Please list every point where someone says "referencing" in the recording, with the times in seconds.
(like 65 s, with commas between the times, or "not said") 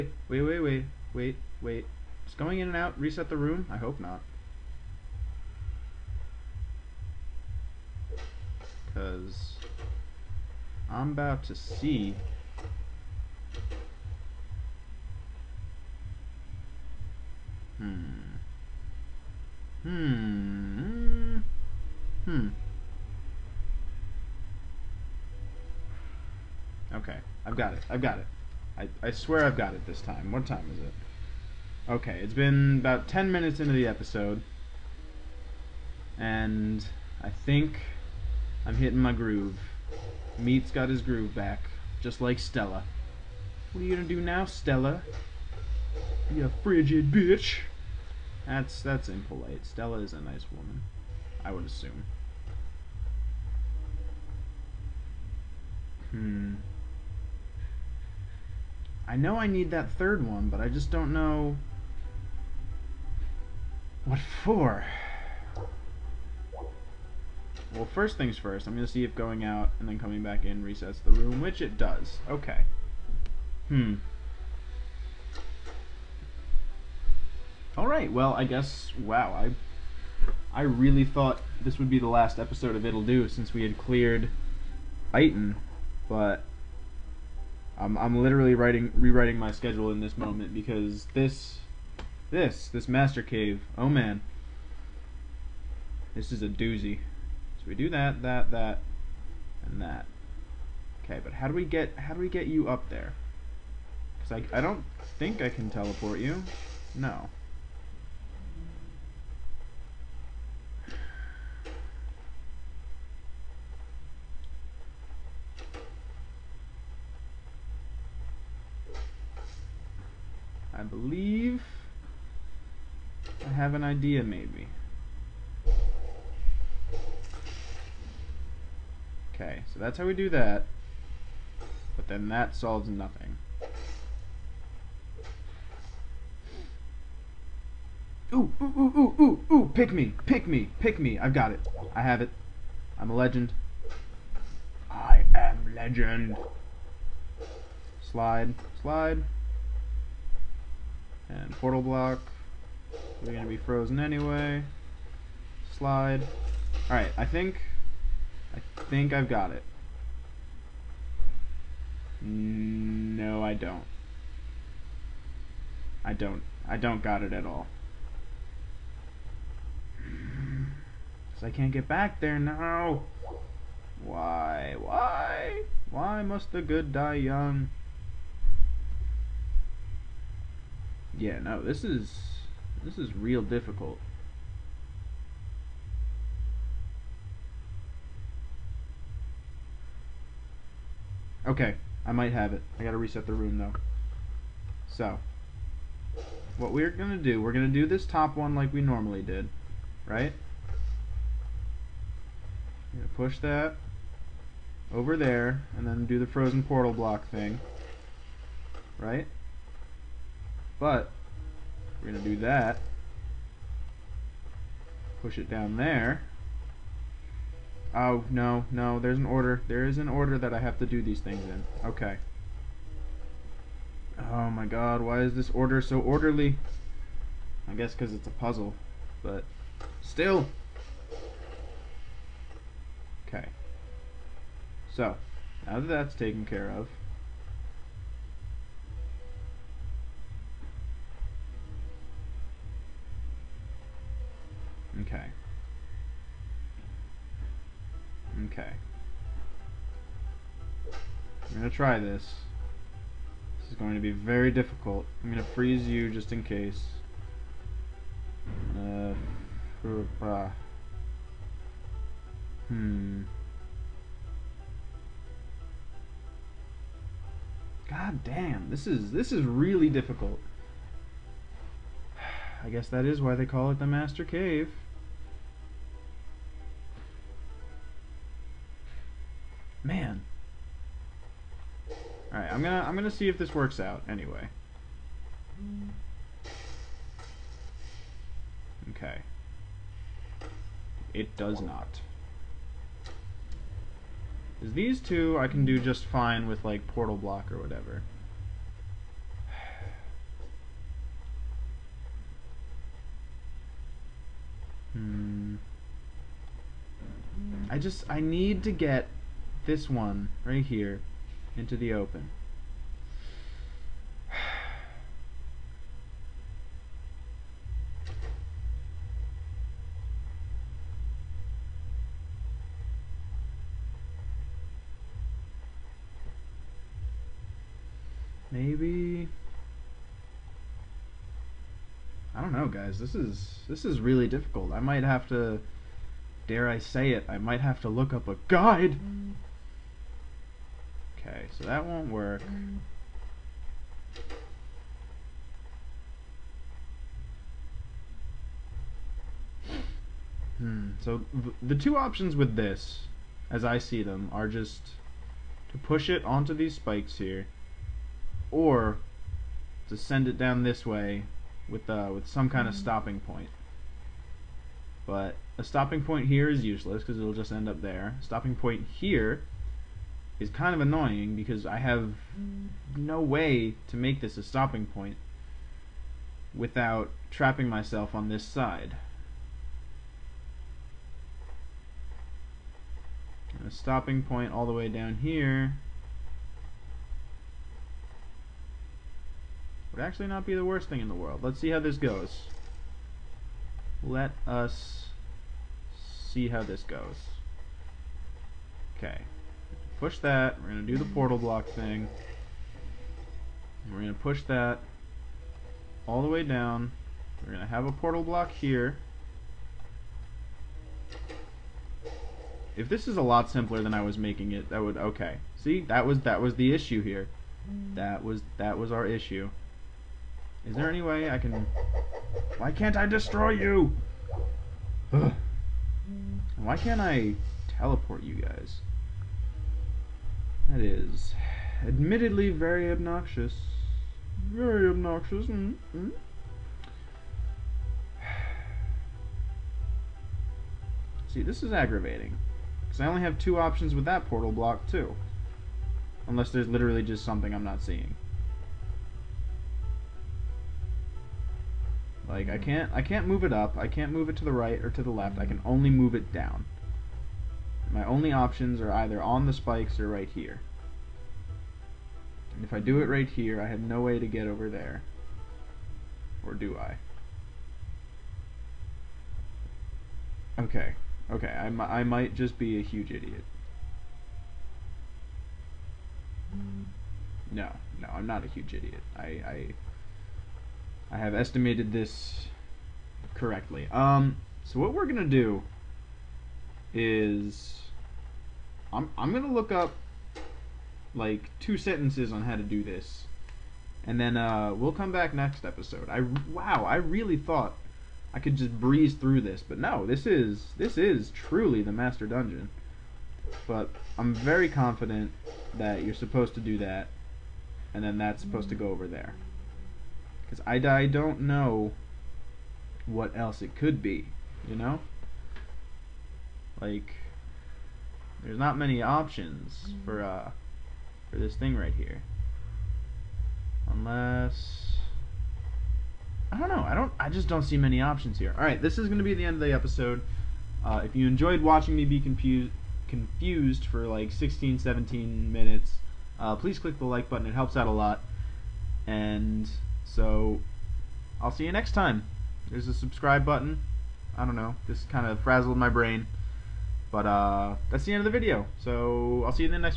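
not said.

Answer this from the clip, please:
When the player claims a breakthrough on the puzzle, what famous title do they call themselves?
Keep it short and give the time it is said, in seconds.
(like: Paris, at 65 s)
I am legend, at 144 s.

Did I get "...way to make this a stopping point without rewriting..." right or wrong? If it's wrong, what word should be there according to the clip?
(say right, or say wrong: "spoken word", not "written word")
wrong: "trapping", not "rewriting".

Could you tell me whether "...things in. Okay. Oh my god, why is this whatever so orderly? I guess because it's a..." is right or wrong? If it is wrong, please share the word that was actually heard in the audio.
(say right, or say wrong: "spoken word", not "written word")
wrong: "order", not "whatever".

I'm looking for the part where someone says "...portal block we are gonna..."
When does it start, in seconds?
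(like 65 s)
151 s.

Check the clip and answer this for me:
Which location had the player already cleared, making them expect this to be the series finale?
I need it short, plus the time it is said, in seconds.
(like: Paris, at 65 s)
Iton, at 85 s.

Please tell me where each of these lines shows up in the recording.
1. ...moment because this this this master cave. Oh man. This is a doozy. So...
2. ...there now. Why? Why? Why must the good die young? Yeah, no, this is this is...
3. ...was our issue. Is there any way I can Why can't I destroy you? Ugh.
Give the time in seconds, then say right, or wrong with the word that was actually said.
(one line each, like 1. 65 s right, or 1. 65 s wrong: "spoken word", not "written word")
1. 90 s right
2. 172 s right
3. 418 s right.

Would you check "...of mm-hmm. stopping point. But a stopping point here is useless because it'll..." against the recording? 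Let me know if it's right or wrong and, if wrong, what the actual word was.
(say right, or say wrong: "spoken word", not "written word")
right.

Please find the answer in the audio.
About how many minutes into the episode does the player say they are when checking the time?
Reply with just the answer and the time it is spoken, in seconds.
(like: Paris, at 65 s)
10, at 33 s.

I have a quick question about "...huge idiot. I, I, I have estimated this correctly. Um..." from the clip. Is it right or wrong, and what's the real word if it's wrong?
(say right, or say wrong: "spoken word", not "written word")
right.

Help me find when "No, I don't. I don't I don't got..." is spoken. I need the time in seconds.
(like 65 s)
162 s.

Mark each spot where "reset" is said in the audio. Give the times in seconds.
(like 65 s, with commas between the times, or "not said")
2 s, 70 s, 192 s.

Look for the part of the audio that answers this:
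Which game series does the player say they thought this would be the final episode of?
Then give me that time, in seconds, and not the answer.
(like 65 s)
82 s.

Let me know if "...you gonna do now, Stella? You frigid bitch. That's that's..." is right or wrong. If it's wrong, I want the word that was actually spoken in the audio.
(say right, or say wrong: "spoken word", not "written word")
right.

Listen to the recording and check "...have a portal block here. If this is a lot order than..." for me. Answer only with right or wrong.
wrong.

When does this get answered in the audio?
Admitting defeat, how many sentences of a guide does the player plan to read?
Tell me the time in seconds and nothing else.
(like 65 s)
491 s.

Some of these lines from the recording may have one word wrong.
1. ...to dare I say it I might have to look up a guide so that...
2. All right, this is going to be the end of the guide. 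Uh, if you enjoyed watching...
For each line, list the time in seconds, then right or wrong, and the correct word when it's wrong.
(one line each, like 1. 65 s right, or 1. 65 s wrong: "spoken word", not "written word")
1. 335 s right
2. 528 s wrong: "episode", not "guide".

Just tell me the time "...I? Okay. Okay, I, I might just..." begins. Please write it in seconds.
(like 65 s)
466 s.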